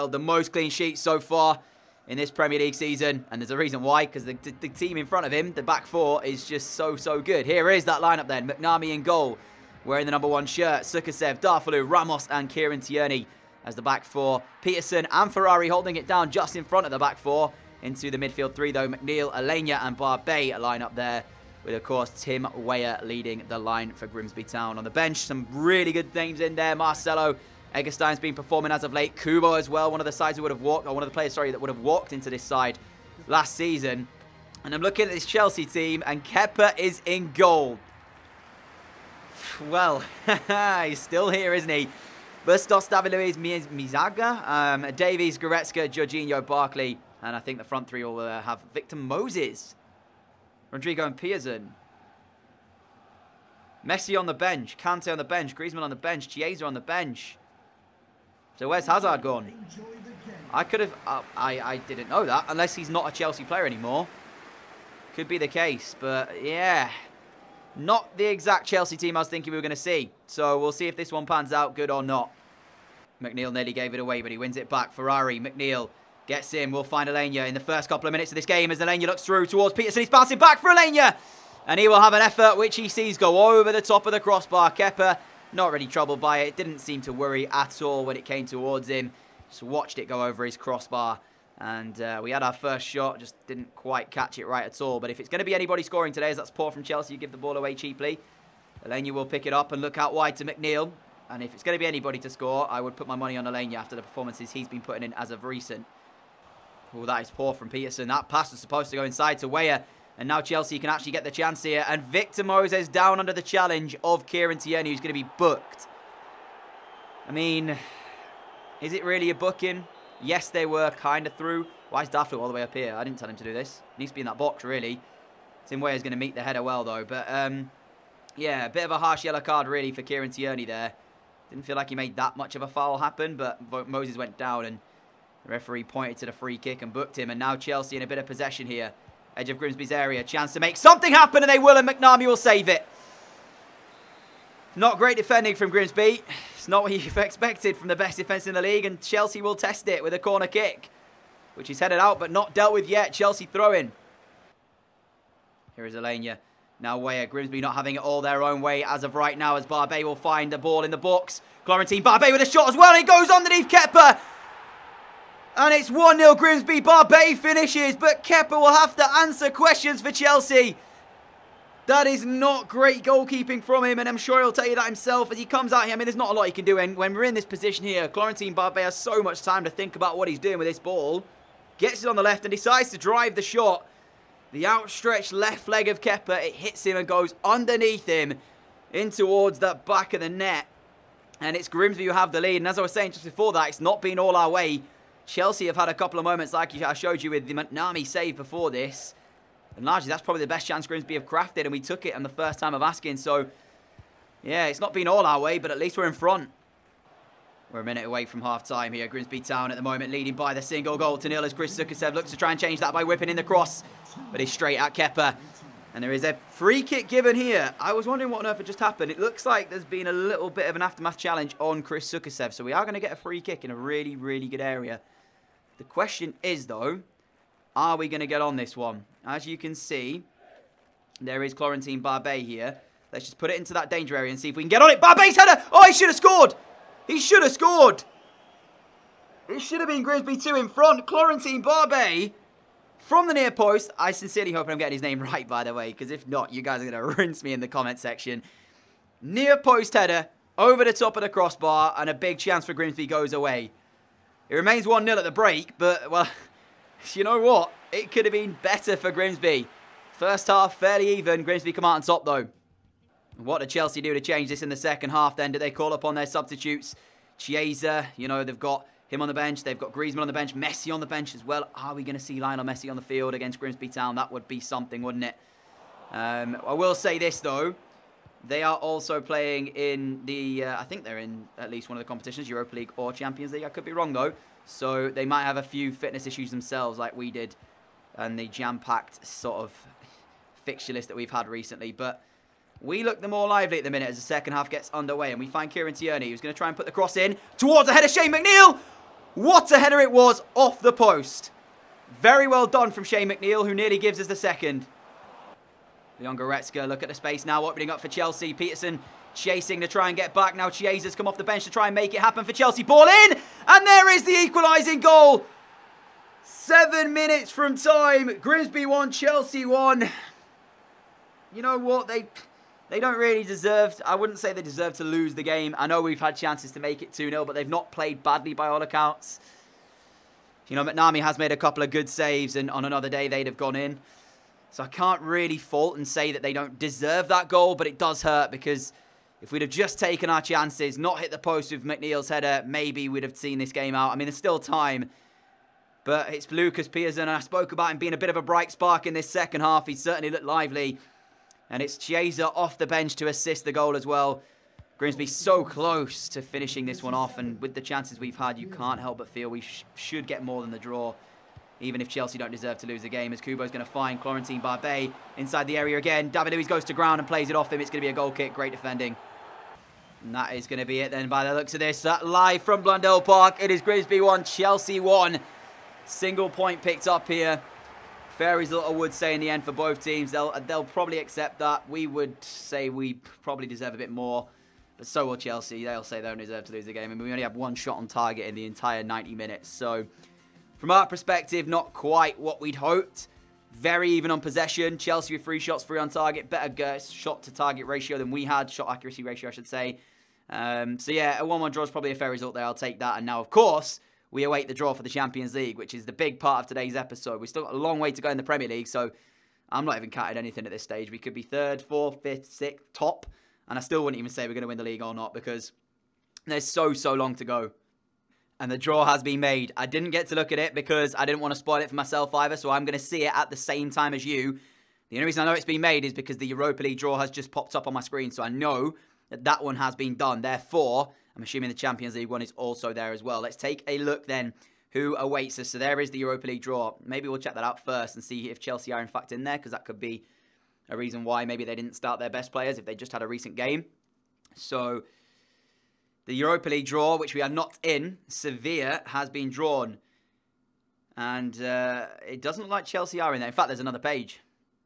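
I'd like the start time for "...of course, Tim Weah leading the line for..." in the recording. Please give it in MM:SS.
00:21.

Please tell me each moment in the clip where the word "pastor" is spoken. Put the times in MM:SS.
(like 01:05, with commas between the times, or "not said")
not said.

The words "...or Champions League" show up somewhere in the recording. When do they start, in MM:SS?
04:42.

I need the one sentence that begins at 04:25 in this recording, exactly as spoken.
Did they call upon their substitutes?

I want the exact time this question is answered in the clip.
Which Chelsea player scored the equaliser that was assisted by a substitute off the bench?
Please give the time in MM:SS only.
05:46.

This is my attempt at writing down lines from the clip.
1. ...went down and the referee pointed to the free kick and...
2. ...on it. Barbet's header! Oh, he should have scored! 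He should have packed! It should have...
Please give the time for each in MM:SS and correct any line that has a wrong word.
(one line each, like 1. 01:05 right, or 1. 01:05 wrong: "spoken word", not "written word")
1. 02:14 right
2. 03:54 wrong: "scored", not "packed".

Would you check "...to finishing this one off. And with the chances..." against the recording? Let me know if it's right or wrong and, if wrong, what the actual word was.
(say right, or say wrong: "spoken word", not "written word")
right.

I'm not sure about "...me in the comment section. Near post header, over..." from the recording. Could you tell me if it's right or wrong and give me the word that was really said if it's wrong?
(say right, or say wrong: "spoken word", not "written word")
right.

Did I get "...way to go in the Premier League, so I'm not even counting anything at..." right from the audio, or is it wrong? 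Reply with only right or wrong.
right.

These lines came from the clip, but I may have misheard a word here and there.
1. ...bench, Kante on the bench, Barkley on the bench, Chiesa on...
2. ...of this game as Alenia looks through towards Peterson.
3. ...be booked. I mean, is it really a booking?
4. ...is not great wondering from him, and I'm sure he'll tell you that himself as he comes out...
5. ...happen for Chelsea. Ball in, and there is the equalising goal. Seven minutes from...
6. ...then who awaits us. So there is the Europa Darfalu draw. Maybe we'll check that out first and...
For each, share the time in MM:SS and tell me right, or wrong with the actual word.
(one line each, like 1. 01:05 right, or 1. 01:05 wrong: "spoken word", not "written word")
1. 00:54 wrong: "Griezmann", not "Barkley"
2. 01:18 right
3. 01:55 right
4. 02:52 wrong: "goalkeeping", not "wondering"
5. 05:12 right
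6. 07:14 wrong: "League", not "Darfalu".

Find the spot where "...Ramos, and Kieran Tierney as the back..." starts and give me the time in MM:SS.
00:11.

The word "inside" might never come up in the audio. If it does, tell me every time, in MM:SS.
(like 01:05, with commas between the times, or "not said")
01:49, 06:05.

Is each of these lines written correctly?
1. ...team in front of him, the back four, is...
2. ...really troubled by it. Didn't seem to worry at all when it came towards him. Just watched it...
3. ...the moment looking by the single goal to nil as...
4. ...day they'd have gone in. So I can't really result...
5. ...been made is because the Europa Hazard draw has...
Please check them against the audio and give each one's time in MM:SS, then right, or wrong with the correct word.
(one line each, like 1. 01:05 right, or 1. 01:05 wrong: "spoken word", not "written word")
1. 00:04 right
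2. 01:25 right
3. 03:29 wrong: "leading", not "looking"
4. 05:33 wrong: "fault", not "result"
5. 07:05 wrong: "League", not "Hazard".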